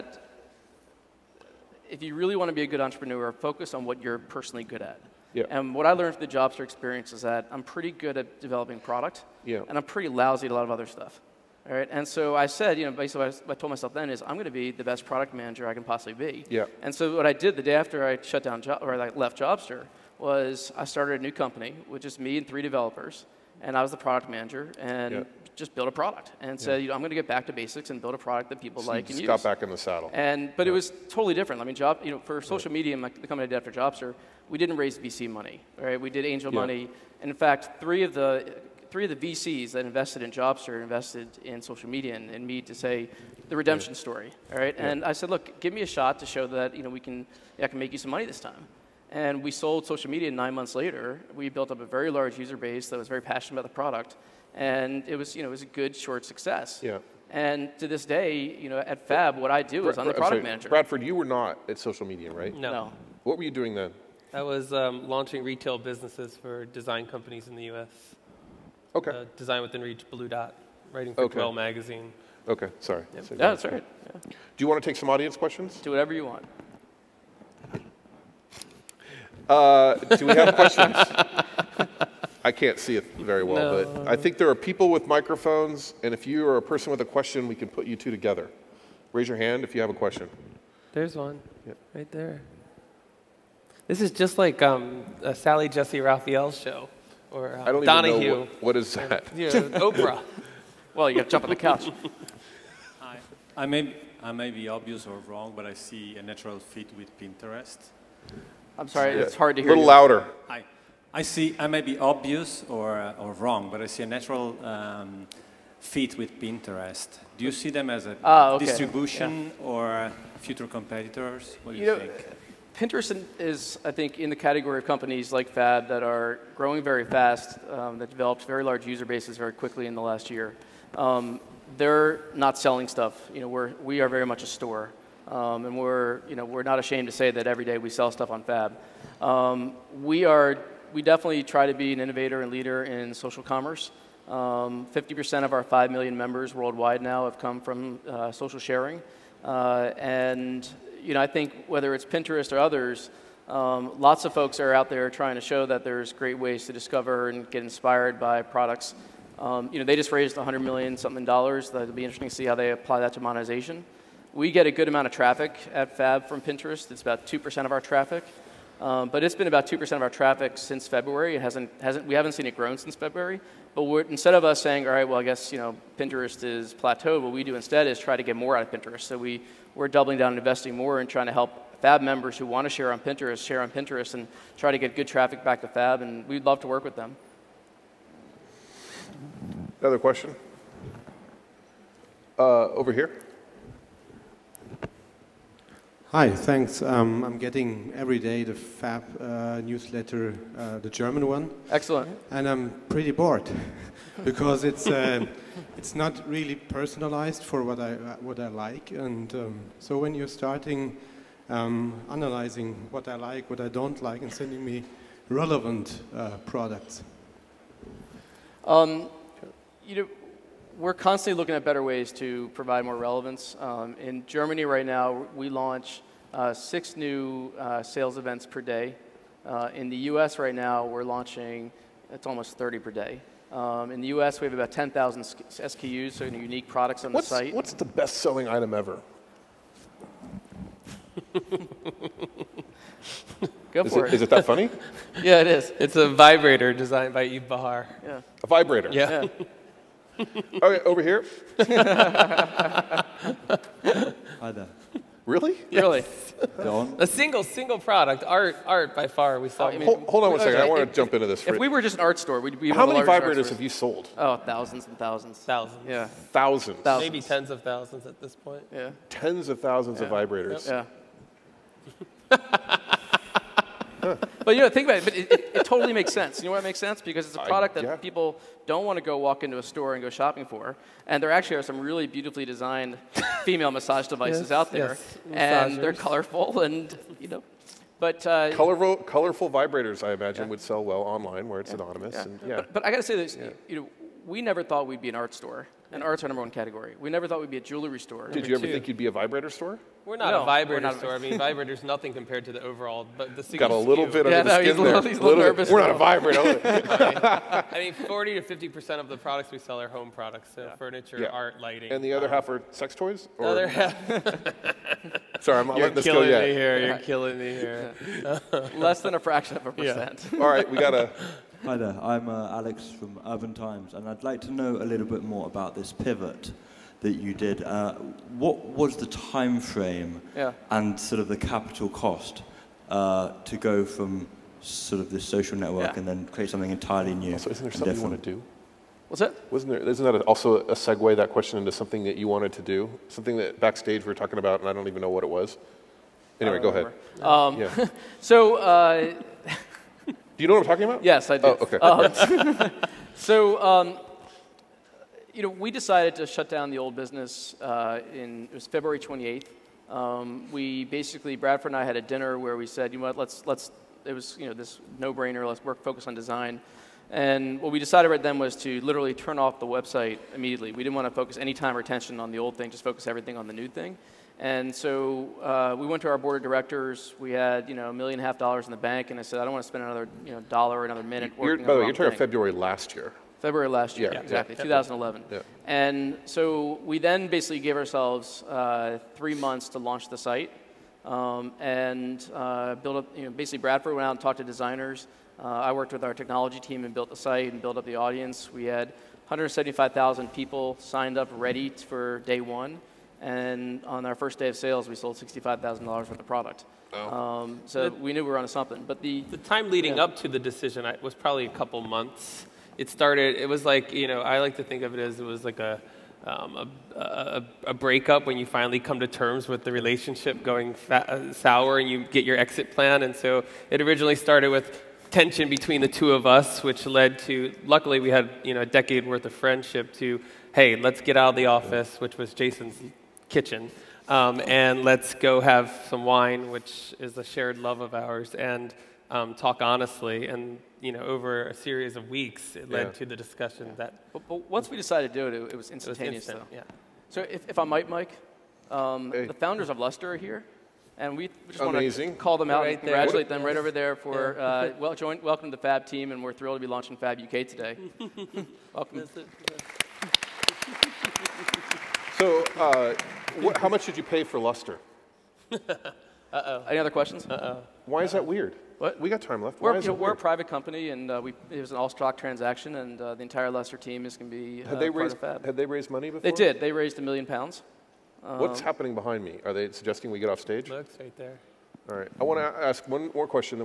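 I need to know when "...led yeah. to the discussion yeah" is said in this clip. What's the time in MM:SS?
07:22.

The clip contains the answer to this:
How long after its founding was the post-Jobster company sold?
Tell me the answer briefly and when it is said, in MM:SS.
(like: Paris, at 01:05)
9 months, at 00:50.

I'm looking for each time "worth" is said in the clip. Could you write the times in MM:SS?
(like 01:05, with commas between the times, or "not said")
06:45, 07:09.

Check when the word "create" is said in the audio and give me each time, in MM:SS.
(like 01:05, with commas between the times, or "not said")
05:36.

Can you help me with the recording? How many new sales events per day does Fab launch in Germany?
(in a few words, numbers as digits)
6.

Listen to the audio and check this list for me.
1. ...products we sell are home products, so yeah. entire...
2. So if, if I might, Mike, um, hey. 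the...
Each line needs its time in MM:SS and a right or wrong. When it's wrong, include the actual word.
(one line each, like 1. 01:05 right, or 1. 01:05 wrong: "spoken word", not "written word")
1. 05:09 wrong: "furniture", not "entire"
2. 07:27 right.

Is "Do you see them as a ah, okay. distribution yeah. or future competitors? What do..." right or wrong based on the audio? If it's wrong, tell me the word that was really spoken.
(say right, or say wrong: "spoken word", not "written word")
right.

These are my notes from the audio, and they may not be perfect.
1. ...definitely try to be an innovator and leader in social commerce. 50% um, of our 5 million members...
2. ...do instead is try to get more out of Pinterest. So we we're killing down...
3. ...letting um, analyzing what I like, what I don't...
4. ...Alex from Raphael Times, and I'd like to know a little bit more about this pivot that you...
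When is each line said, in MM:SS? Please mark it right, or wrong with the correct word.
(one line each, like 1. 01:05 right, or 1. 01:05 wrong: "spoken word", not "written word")
1. 02:21 right
2. 02:57 wrong: "doubling", not "killing"
3. 03:30 wrong: "starting", not "letting"
4. 05:22 wrong: "Urban", not "Raphael".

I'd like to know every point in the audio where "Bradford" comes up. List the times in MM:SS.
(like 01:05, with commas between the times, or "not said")
01:00, 06:01, 06:33.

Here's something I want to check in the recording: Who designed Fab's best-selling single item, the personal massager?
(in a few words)
Yves Béhar.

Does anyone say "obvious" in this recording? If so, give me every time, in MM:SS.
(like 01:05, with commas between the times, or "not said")
01:44, 01:51.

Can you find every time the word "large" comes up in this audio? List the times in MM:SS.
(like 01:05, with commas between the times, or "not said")
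00:52, 02:08.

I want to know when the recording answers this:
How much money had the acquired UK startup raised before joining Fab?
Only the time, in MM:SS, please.
07:56.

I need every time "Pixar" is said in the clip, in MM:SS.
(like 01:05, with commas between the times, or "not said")
not said.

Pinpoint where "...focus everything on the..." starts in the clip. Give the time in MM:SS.
06:12.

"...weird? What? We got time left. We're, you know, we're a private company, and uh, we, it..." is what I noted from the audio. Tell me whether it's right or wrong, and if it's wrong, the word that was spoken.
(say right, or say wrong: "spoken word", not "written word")
right.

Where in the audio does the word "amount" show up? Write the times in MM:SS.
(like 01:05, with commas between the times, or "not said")
02:44.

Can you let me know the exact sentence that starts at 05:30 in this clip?
and sort of the capital cost uh, to go from sort of this social network yeah.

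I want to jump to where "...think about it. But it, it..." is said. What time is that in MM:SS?
04:34.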